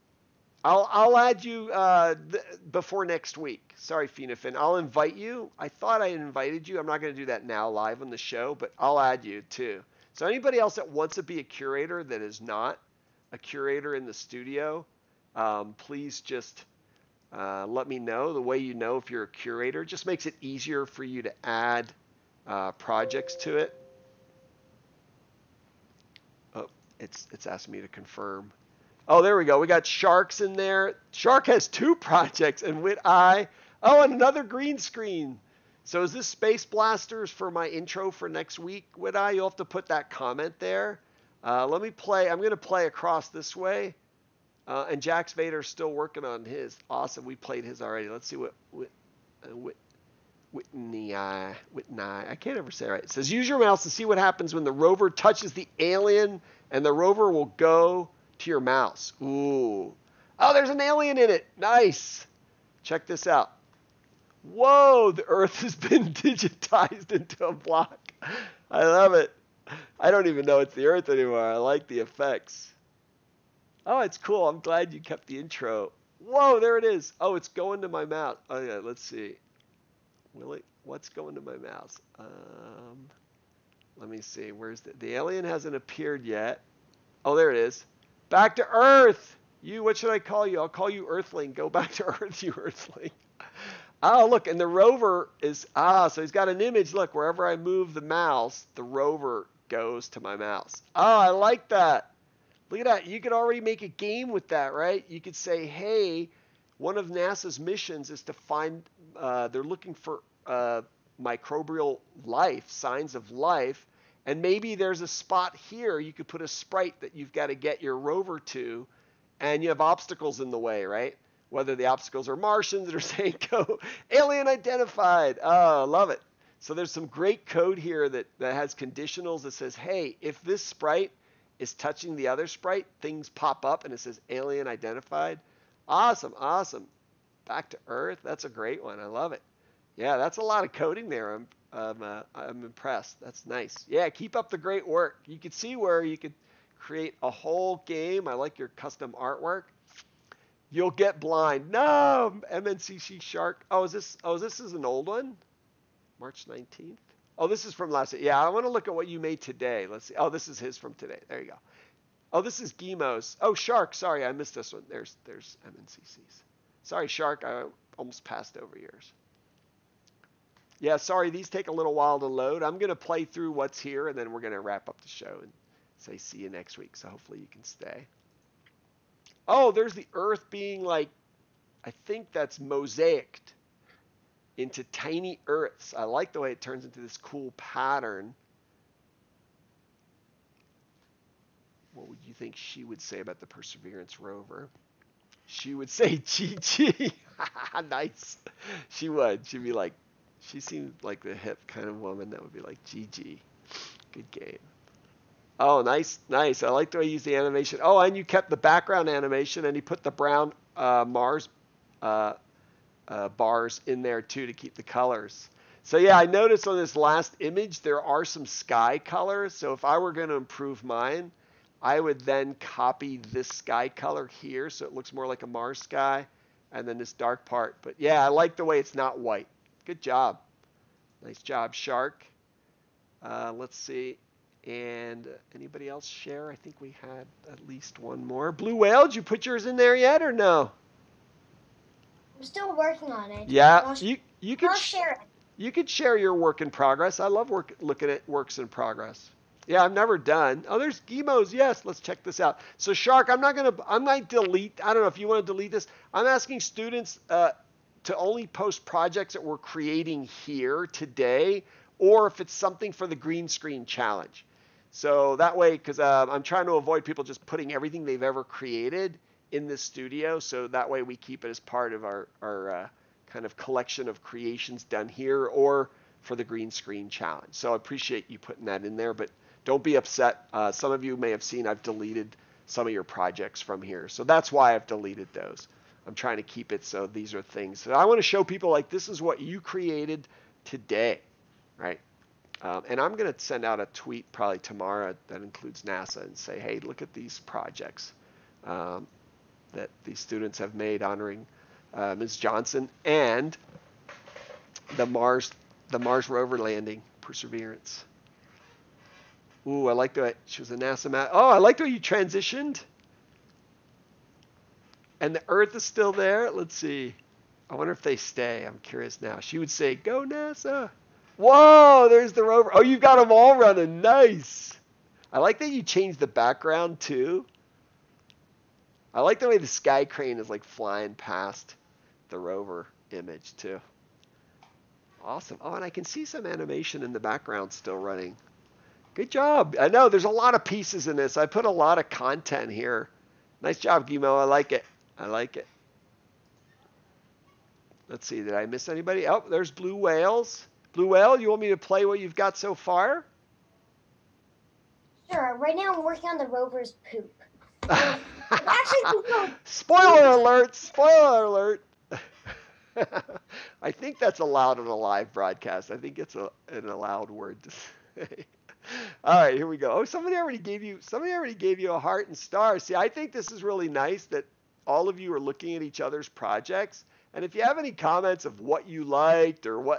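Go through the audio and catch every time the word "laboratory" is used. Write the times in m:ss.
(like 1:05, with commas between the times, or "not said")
not said.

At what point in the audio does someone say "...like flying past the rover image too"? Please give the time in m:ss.
5:30.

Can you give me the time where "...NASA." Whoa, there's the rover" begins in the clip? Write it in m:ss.
5:20.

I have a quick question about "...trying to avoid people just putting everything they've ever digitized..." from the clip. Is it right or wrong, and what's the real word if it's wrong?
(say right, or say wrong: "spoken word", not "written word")
wrong: "created", not "digitized".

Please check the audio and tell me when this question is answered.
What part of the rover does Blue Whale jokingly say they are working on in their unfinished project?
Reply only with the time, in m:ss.
5:56.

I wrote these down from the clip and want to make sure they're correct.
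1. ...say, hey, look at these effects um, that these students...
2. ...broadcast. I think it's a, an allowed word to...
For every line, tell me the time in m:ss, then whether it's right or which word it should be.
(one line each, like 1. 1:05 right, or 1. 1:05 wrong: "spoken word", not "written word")
1. 4:56 wrong: "projects", not "effects"
2. 6:05 right.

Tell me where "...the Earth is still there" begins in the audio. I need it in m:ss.
5:15.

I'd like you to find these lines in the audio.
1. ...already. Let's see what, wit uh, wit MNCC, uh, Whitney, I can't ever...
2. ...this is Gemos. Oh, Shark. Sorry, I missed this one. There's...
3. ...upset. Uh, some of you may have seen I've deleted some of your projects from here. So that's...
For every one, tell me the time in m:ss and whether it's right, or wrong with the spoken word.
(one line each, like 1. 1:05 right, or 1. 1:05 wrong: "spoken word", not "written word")
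1. 0:47 wrong: "Whitney", not "MNCC"
2. 2:42 right
3. 4:39 right.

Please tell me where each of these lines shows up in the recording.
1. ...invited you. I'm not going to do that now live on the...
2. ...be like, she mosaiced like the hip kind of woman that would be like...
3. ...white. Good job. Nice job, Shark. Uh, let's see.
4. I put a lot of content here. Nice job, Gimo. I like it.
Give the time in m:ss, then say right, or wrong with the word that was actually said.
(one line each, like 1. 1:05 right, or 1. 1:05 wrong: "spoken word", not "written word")
1. 0:06 right
2. 3:19 wrong: "seemed", not "mosaiced"
3. 3:49 right
4. 5:41 right.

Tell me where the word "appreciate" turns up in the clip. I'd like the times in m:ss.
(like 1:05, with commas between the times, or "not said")
4:37.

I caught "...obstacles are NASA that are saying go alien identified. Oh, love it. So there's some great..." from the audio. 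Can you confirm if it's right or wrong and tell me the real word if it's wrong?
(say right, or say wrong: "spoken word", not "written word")
wrong: "Martians", not "NASA".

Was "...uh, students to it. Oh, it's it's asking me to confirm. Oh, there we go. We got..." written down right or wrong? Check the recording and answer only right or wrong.
wrong.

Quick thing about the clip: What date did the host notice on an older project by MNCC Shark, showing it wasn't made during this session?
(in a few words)
March 19th.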